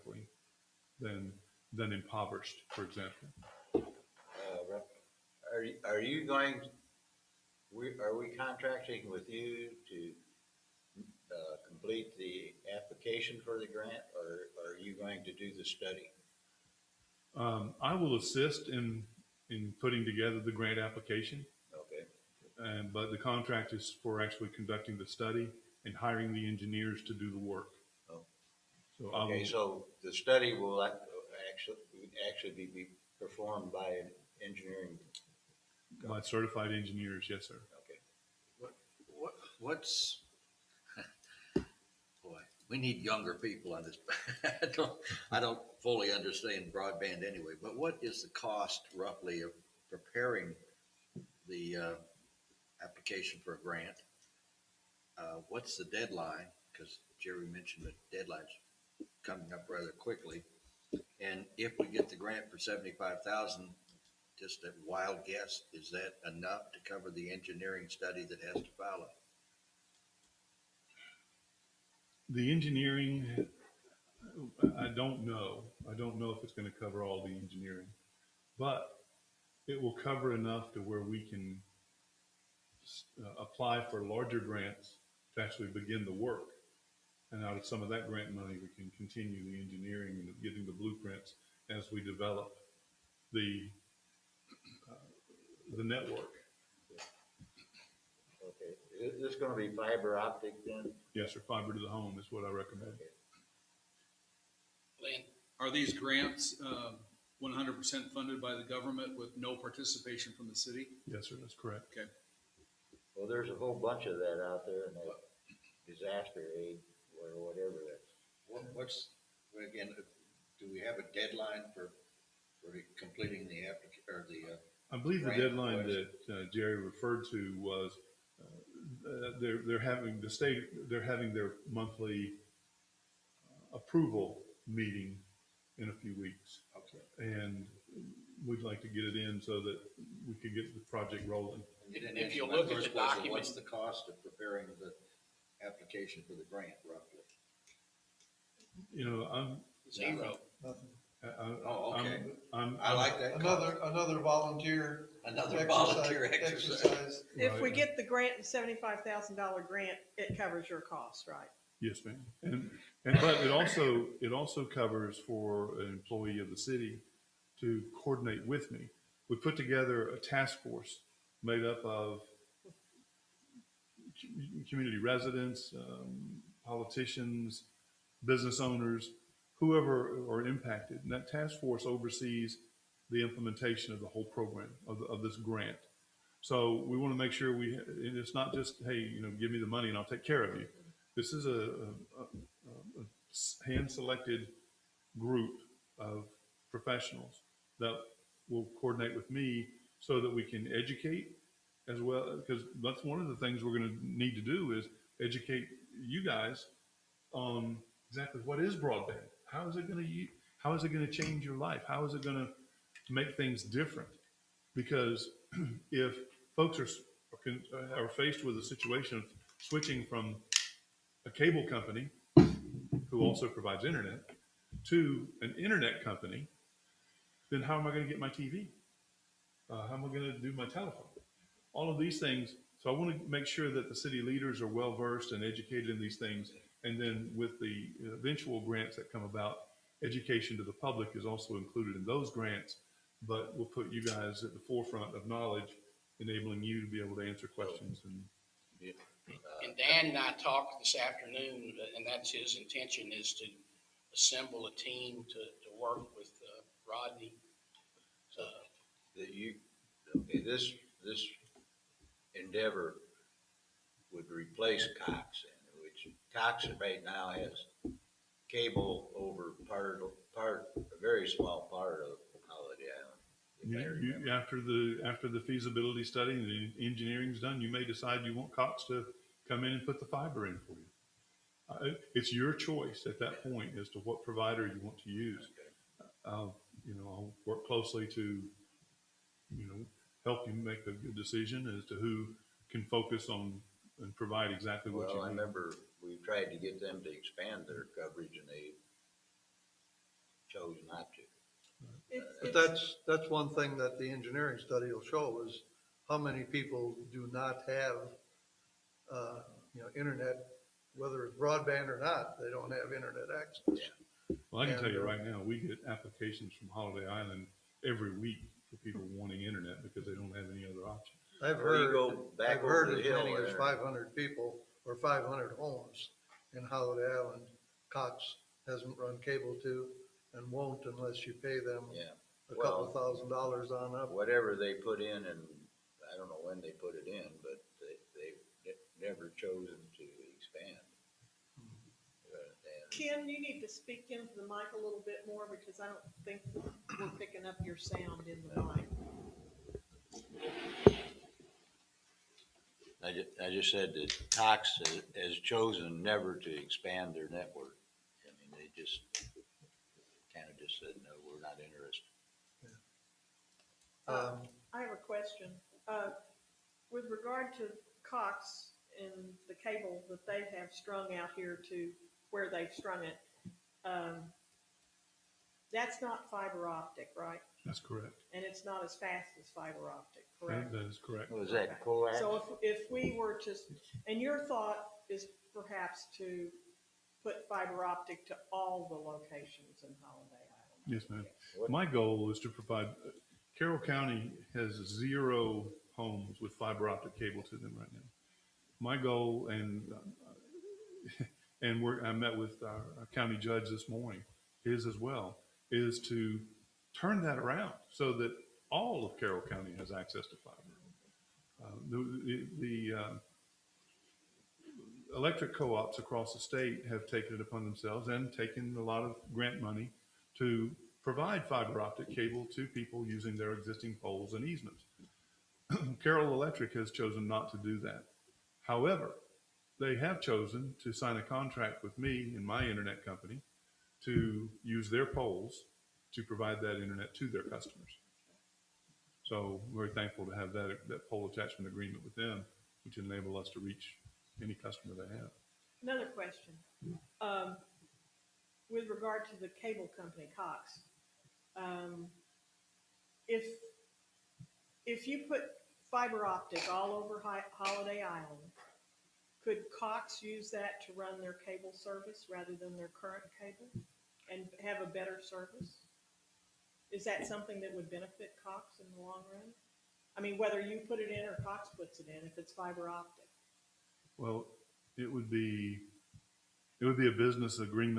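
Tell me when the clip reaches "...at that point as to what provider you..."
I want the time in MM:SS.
04:43.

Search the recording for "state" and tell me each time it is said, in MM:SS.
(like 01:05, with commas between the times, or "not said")
02:10, 06:56.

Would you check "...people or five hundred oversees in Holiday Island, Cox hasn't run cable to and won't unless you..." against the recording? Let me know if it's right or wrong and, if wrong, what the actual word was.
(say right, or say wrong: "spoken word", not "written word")
wrong: "homes", not "oversees".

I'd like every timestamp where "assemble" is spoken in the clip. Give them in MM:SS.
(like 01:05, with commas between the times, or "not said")
04:14.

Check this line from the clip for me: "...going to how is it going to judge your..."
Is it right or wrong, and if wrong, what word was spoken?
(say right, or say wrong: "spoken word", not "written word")
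wrong: "change", not "judge".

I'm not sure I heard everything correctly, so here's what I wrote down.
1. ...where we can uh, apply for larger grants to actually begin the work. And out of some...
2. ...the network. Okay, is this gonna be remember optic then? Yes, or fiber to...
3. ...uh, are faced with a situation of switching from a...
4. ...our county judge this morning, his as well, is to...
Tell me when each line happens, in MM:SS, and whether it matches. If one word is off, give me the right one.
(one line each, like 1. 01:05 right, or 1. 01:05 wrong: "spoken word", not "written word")
1. 01:20 right
2. 01:35 wrong: "fiber", not "remember"
3. 03:37 right
4. 06:42 right.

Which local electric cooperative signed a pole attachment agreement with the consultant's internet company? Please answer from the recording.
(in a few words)
Carroll Electric.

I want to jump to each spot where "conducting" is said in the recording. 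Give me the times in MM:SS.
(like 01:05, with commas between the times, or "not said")
00:24.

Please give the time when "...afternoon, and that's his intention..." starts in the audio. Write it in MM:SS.
04:10.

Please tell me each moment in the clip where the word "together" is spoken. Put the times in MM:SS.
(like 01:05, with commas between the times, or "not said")
00:20, 02:49.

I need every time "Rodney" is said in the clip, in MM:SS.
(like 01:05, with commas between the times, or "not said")
04:16.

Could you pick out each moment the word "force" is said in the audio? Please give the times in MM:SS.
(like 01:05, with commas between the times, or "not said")
02:50, 03:01.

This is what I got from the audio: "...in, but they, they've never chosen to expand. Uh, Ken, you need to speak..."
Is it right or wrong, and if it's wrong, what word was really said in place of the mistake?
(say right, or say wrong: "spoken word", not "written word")
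right.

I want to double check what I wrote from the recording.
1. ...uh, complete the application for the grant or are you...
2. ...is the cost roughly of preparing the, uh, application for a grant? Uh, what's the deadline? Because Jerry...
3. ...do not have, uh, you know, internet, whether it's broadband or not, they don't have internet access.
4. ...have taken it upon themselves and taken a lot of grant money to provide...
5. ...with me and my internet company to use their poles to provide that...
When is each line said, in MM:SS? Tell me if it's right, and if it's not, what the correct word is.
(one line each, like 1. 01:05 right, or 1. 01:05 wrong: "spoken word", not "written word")
1. 00:10 right
2. 00:48 right
3. 05:07 right
4. 06:56 right
5. 07:11 right.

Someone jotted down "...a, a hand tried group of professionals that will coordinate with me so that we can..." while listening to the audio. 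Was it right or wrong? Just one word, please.
wrong.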